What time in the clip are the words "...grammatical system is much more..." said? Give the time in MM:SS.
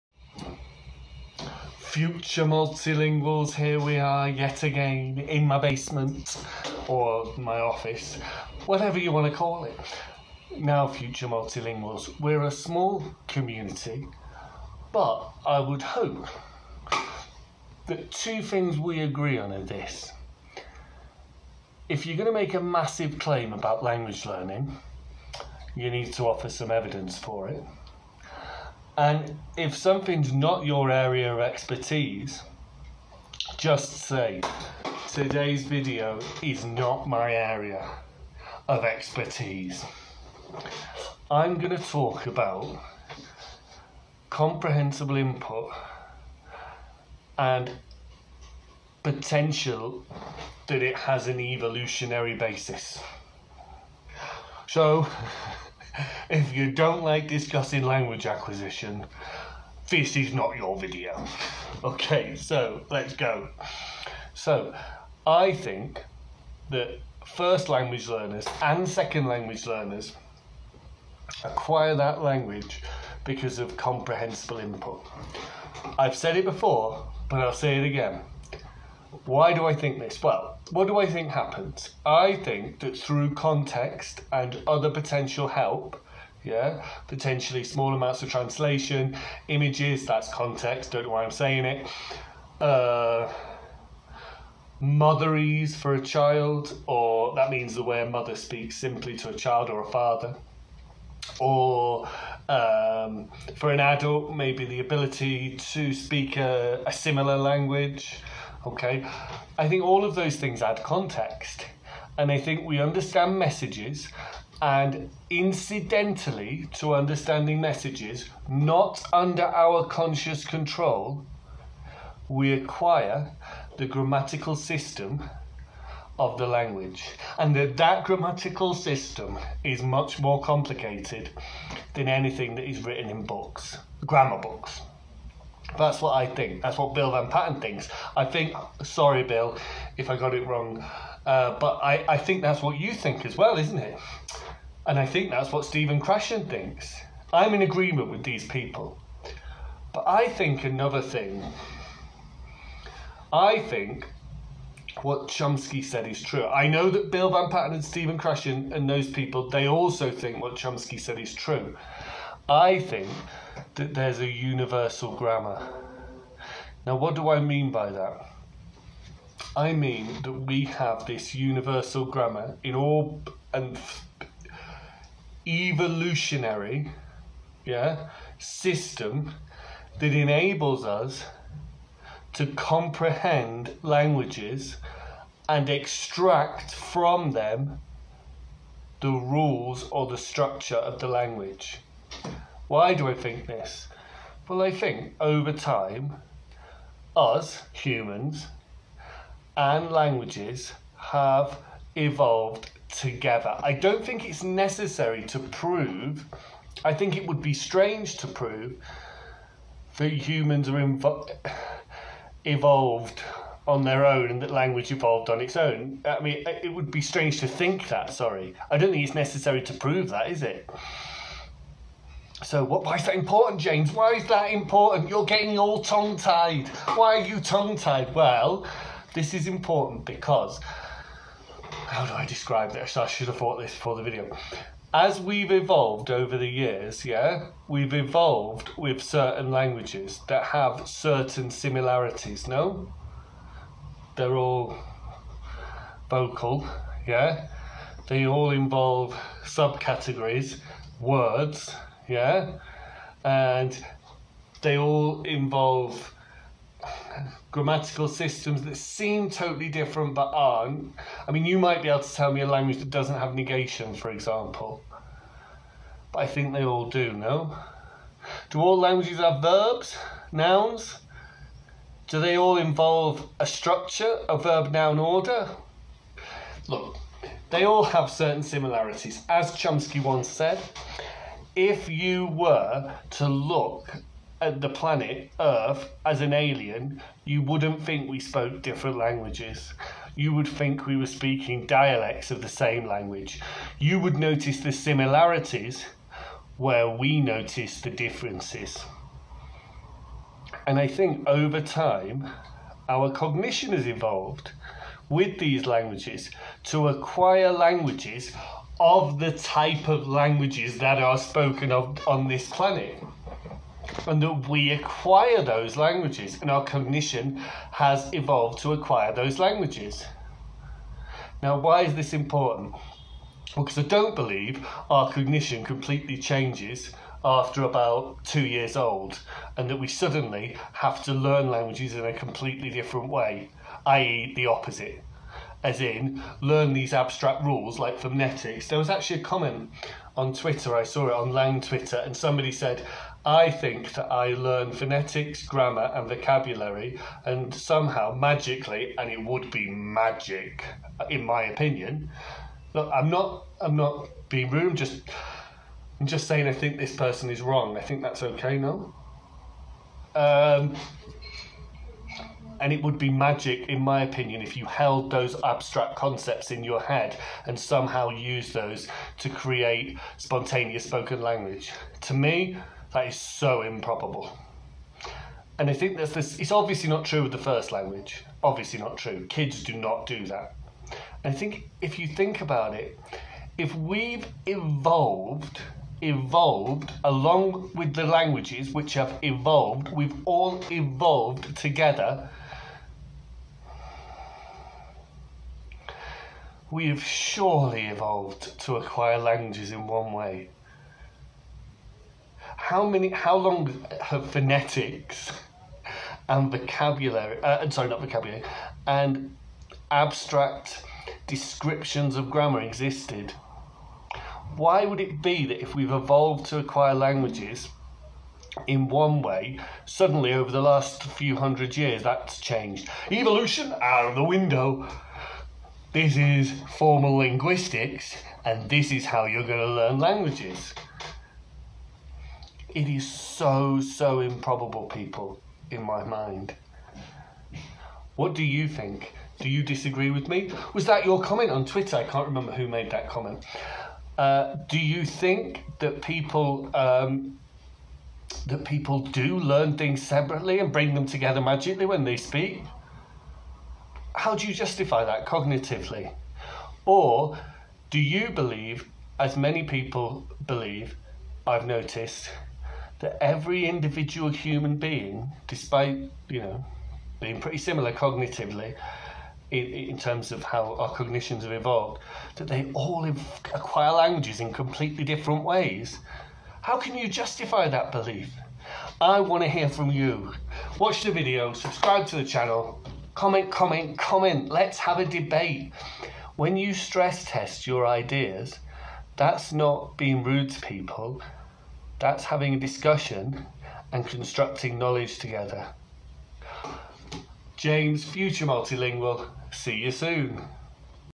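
02:08.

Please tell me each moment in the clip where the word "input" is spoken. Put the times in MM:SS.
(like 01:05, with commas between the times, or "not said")
00:45, 01:14.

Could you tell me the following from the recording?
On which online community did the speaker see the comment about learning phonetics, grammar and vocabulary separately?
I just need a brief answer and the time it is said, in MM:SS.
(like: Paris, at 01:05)
Lang Twitter, at 05:41.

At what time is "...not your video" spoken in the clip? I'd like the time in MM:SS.
01:00.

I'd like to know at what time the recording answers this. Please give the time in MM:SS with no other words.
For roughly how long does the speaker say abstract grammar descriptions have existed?
07:00.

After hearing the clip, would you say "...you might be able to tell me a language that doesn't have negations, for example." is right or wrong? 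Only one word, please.
right.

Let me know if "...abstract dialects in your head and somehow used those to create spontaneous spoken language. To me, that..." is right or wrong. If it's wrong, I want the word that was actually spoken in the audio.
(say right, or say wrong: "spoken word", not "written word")
wrong: "concepts", not "dialects".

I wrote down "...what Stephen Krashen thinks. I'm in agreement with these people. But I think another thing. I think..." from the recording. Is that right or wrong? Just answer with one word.
right.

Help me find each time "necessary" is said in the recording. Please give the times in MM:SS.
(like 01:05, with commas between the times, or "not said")
03:24, 03:39.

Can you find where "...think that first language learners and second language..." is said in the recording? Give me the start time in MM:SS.
01:05.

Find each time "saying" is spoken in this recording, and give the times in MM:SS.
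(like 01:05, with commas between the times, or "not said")
01:31, 05:56.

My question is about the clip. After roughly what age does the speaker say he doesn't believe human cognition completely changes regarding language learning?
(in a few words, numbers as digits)
2 years old.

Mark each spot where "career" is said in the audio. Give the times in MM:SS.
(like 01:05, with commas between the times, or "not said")
not said.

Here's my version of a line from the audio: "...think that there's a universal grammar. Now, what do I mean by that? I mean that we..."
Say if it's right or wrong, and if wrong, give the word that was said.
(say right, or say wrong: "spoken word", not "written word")
right.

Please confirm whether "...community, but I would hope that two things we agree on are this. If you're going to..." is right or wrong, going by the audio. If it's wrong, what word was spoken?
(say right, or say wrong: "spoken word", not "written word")
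right.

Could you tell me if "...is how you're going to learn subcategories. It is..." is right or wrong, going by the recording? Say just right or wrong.
wrong.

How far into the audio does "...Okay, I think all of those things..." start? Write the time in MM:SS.
01:48.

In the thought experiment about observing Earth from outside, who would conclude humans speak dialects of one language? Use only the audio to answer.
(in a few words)
an alien.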